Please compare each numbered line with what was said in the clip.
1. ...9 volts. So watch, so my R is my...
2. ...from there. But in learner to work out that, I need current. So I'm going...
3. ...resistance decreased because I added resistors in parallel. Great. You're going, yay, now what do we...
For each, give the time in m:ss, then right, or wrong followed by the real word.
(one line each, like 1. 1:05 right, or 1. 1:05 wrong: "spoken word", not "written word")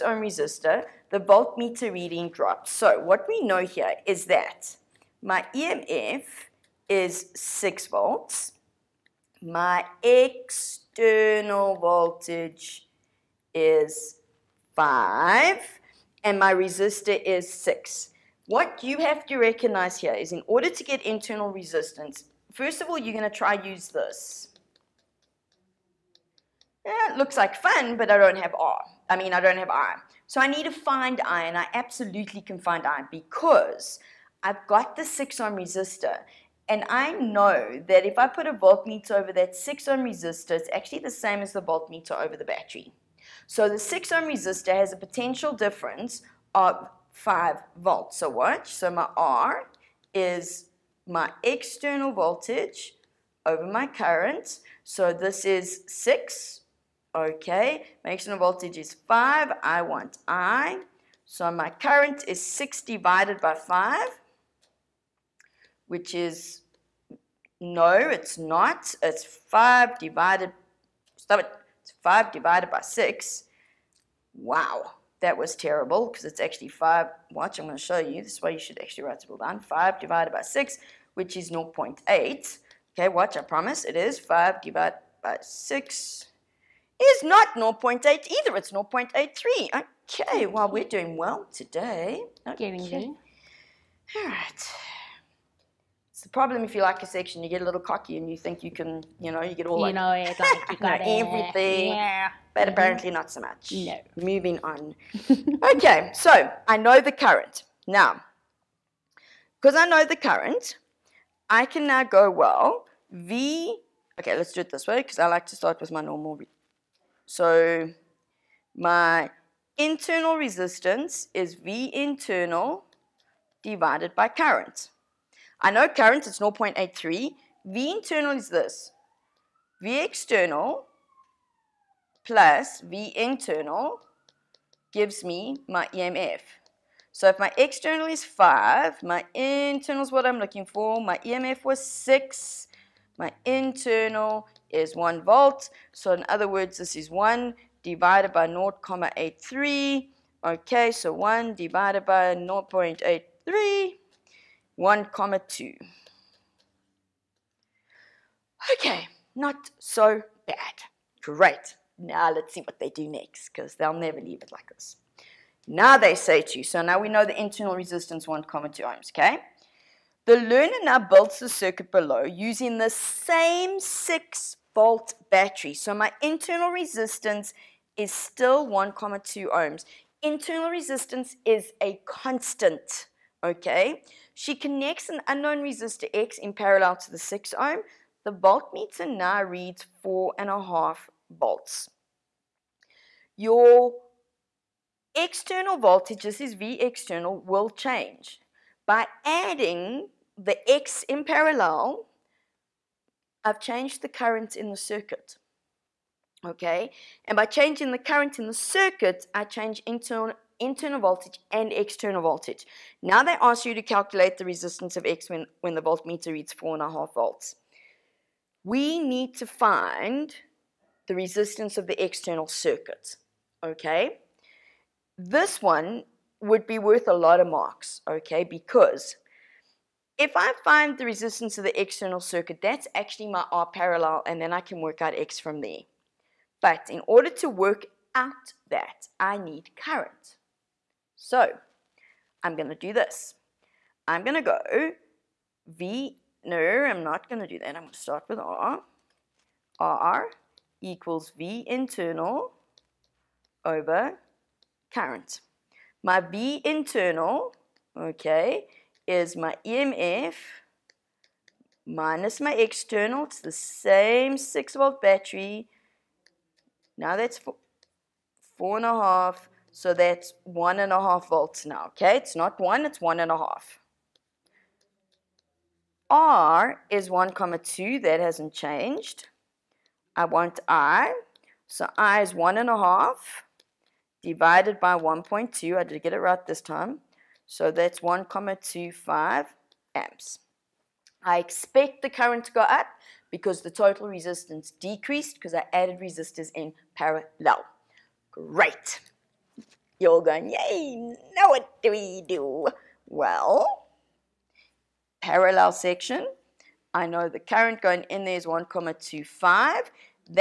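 1. 0:47 wrong: "5", not "9"
2. 3:55 wrong: "order", not "learner"
3. 4:54 right.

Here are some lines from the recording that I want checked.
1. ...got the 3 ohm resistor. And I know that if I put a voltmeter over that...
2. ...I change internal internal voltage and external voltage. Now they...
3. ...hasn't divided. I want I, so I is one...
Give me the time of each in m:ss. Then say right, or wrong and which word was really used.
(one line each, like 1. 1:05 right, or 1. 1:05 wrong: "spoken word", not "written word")
1. 0:34 wrong: "6", not "3"
2. 3:29 right
3. 4:38 wrong: "changed", not "divided".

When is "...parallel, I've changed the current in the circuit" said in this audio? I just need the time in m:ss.
3:21.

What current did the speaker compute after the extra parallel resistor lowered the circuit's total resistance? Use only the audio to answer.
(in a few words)
1.25 amps.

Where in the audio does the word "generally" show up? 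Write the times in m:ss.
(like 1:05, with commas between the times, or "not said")
not said.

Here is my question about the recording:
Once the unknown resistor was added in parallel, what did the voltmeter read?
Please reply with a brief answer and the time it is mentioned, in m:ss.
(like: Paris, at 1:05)
4.5 volts, at 3:08.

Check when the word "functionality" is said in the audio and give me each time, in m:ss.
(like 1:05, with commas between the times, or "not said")
not said.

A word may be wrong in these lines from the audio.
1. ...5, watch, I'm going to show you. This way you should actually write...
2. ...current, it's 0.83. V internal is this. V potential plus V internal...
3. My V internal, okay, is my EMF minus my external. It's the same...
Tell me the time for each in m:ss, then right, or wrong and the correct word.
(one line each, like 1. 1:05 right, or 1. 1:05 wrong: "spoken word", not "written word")
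1. 1:16 right
2. 2:05 wrong: "external", not "potential"
3. 4:16 right.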